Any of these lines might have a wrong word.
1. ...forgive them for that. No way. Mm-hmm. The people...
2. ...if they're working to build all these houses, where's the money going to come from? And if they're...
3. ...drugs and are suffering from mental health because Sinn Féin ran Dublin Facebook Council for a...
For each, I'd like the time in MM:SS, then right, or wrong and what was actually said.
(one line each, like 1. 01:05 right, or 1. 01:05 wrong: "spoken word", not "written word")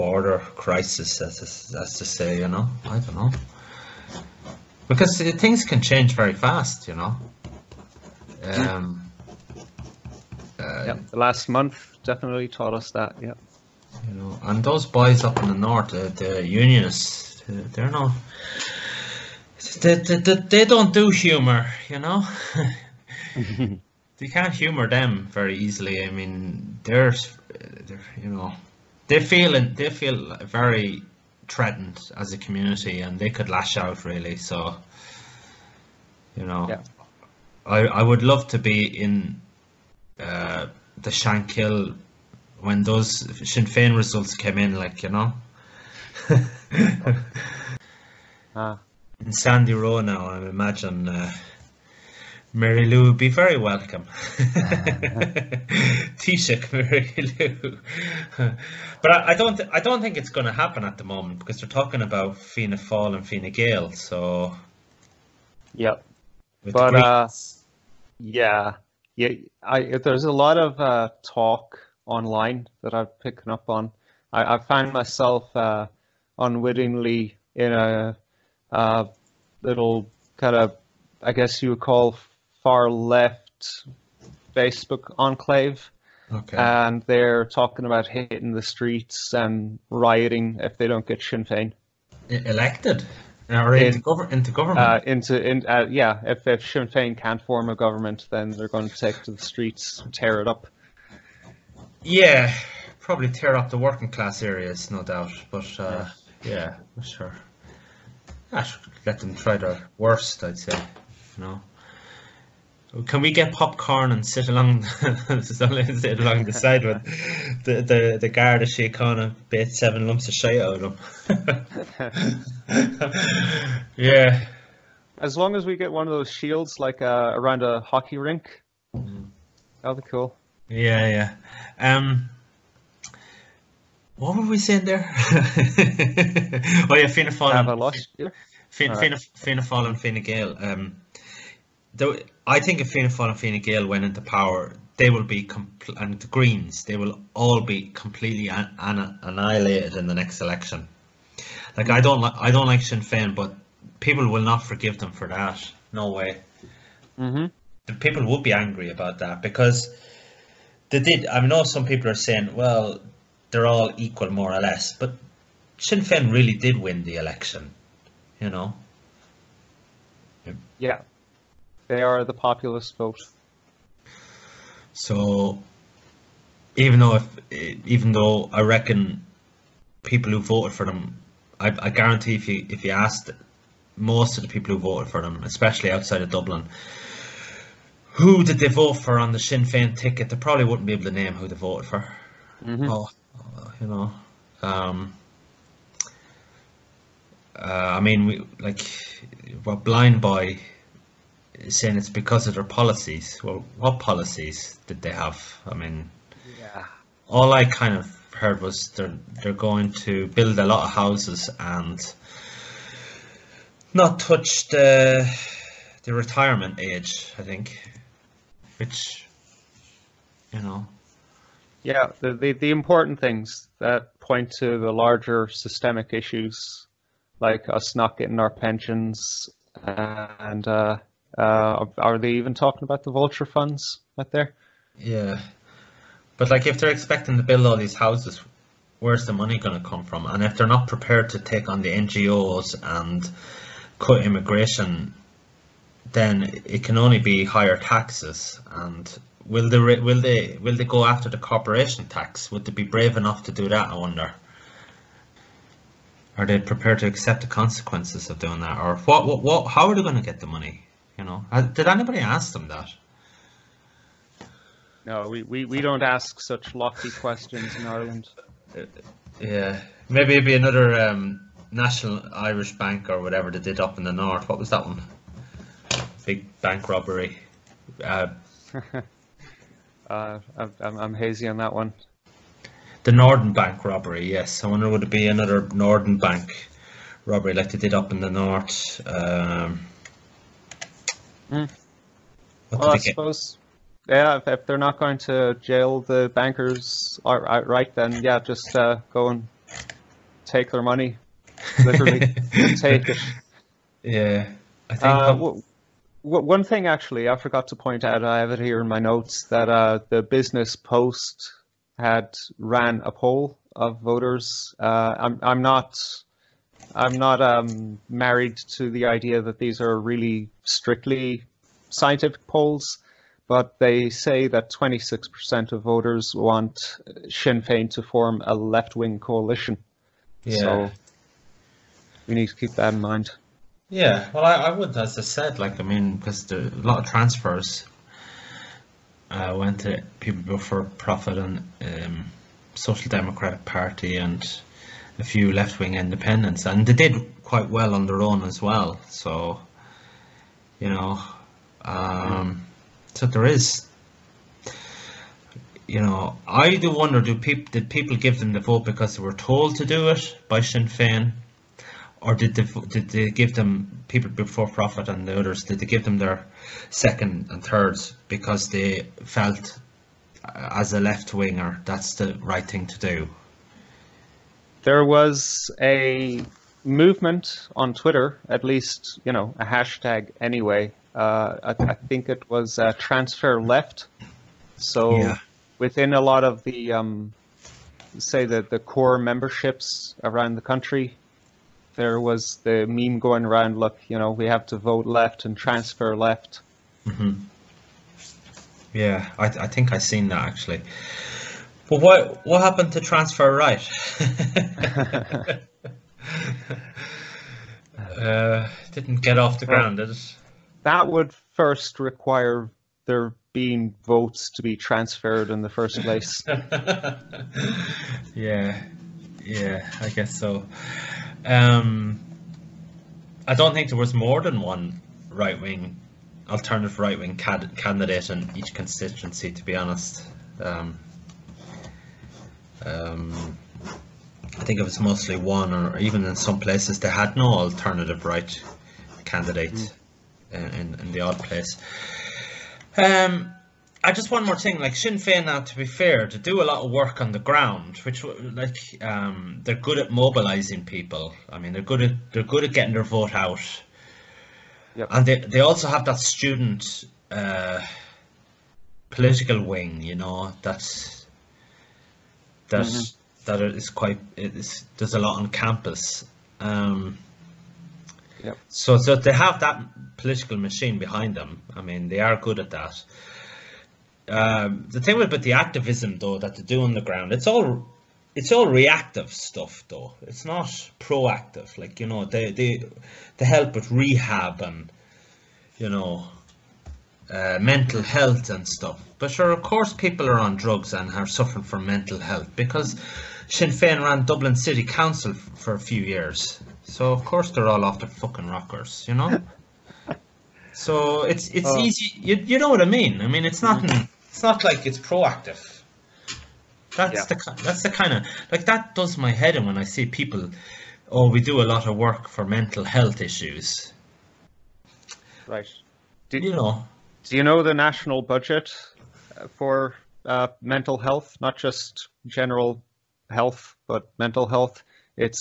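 1. 02:34 right
2. 03:56 wrong: "expecting", not "working"
3. 08:10 wrong: "City", not "Facebook".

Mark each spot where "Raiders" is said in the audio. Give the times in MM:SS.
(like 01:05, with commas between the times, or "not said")
not said.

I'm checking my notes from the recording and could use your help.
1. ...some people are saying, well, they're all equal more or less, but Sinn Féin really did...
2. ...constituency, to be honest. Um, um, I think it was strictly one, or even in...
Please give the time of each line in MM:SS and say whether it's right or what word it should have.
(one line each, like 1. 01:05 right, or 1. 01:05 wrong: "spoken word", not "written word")
1. 02:41 right
2. 07:08 wrong: "mostly", not "strictly".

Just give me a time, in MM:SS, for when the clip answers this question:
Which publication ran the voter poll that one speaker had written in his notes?
05:10.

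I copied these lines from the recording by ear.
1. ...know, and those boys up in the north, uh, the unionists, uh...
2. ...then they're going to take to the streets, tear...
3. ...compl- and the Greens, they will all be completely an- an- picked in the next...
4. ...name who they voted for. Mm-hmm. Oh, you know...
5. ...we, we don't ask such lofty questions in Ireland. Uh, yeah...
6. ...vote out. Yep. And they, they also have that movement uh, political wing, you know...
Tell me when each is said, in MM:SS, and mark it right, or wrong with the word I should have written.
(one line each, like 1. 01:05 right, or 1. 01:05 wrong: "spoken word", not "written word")
1. 00:14 right
2. 01:38 right
3. 02:25 wrong: "annihilated", not "picked"
4. 03:11 right
5. 04:25 right
6. 07:33 wrong: "student", not "movement".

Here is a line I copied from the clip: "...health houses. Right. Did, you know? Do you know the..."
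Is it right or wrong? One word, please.
wrong.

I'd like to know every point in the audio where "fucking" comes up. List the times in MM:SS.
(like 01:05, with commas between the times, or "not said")
08:18.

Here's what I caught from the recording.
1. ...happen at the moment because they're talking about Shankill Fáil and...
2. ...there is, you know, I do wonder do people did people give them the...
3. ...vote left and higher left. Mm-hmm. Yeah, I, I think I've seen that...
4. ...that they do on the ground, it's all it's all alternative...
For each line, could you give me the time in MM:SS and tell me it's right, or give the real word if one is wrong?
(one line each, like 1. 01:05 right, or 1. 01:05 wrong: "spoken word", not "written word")
1. 01:00 wrong: "Fianna", not "Shankill"
2. 05:53 right
3. 06:34 wrong: "transfer", not "higher"
4. 07:56 wrong: "reactive", not "alternative".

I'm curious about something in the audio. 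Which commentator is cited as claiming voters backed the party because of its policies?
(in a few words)
Blindboy.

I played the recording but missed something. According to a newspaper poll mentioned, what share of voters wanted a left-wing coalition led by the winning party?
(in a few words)
26%.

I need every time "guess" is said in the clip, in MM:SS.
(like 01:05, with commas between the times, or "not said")
01:21, 07:00.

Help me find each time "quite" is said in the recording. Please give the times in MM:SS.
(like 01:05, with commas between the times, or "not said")
05:47, 07:43.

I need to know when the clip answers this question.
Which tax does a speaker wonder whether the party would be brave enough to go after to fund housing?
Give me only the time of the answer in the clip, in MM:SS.
04:11.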